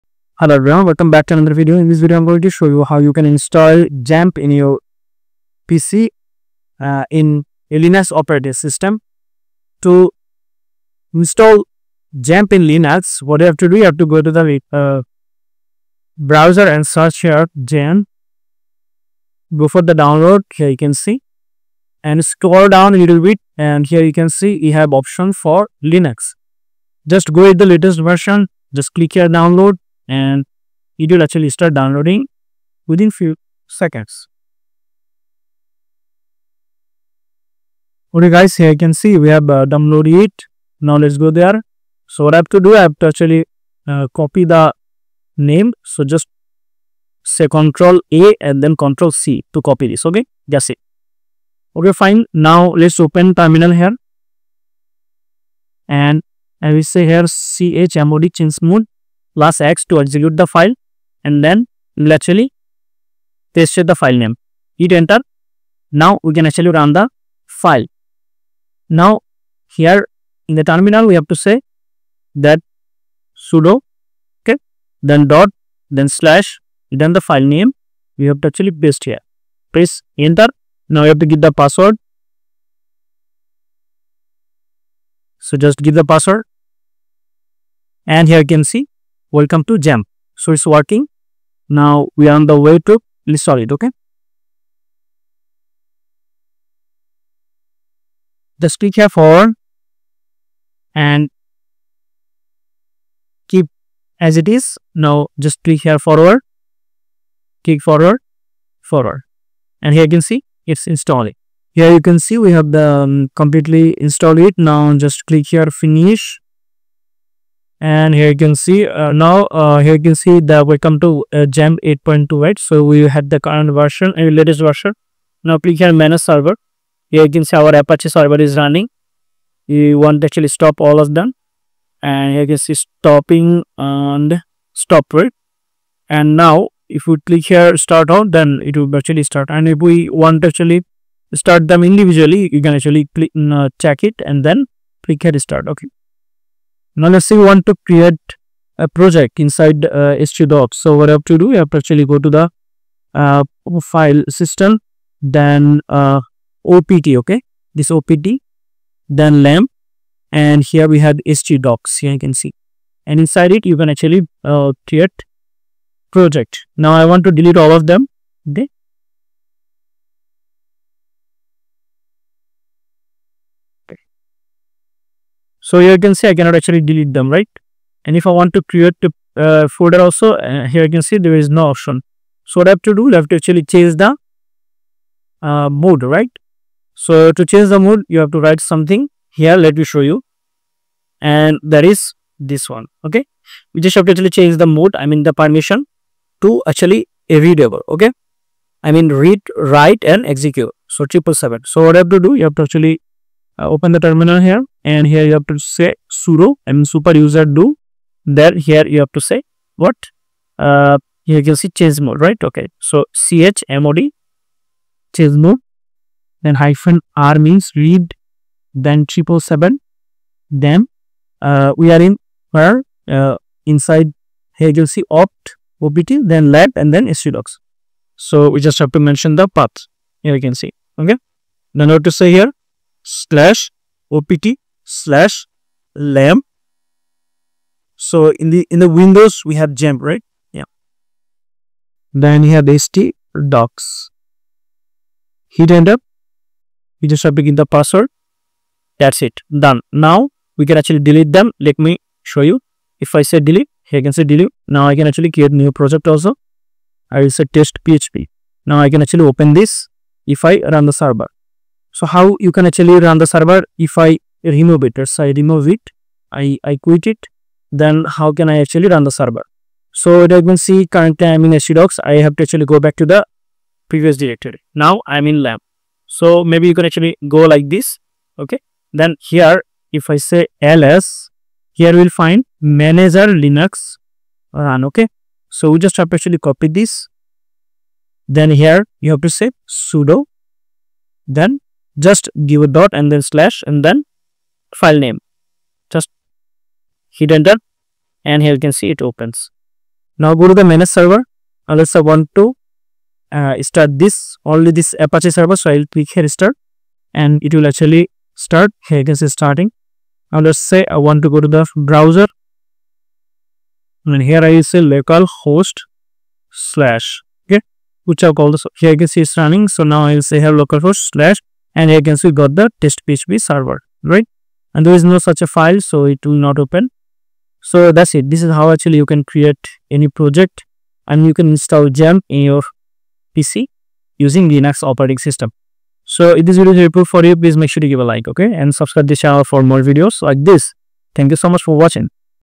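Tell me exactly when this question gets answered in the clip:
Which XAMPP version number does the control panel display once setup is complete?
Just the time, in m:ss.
2:01.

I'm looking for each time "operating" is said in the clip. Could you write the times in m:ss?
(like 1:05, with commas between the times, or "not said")
0:08, 5:34.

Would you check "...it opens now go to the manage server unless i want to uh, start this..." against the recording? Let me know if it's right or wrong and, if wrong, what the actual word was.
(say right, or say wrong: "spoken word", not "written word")
right.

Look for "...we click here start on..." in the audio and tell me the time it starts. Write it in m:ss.
2:17.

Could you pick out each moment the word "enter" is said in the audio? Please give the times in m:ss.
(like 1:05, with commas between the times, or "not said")
1:04, 1:20, 4:57.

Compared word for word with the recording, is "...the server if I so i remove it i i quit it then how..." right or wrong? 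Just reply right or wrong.
right.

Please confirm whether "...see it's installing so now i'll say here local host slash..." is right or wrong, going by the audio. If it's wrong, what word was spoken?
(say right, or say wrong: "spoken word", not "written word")
wrong: "running", not "installing".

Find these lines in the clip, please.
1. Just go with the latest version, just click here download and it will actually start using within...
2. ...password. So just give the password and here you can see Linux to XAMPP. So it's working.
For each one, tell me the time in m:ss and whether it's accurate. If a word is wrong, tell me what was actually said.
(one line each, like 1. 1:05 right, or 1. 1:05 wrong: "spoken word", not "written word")
1. 0:27 wrong: "downloading", not "using"
2. 1:21 wrong: "Welcome", not "Linux".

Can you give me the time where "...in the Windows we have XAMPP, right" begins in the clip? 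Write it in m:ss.
3:58.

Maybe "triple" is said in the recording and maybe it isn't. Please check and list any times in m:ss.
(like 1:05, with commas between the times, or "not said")
3:21, 3:39.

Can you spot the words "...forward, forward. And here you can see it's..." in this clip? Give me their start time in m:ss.
1:47.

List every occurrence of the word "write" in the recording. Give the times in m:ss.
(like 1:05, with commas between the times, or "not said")
3:08, 3:19.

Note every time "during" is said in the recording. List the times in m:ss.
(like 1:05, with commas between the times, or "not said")
not said.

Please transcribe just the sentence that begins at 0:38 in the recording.
Okay guys, here you can see we have uh, downloaded it.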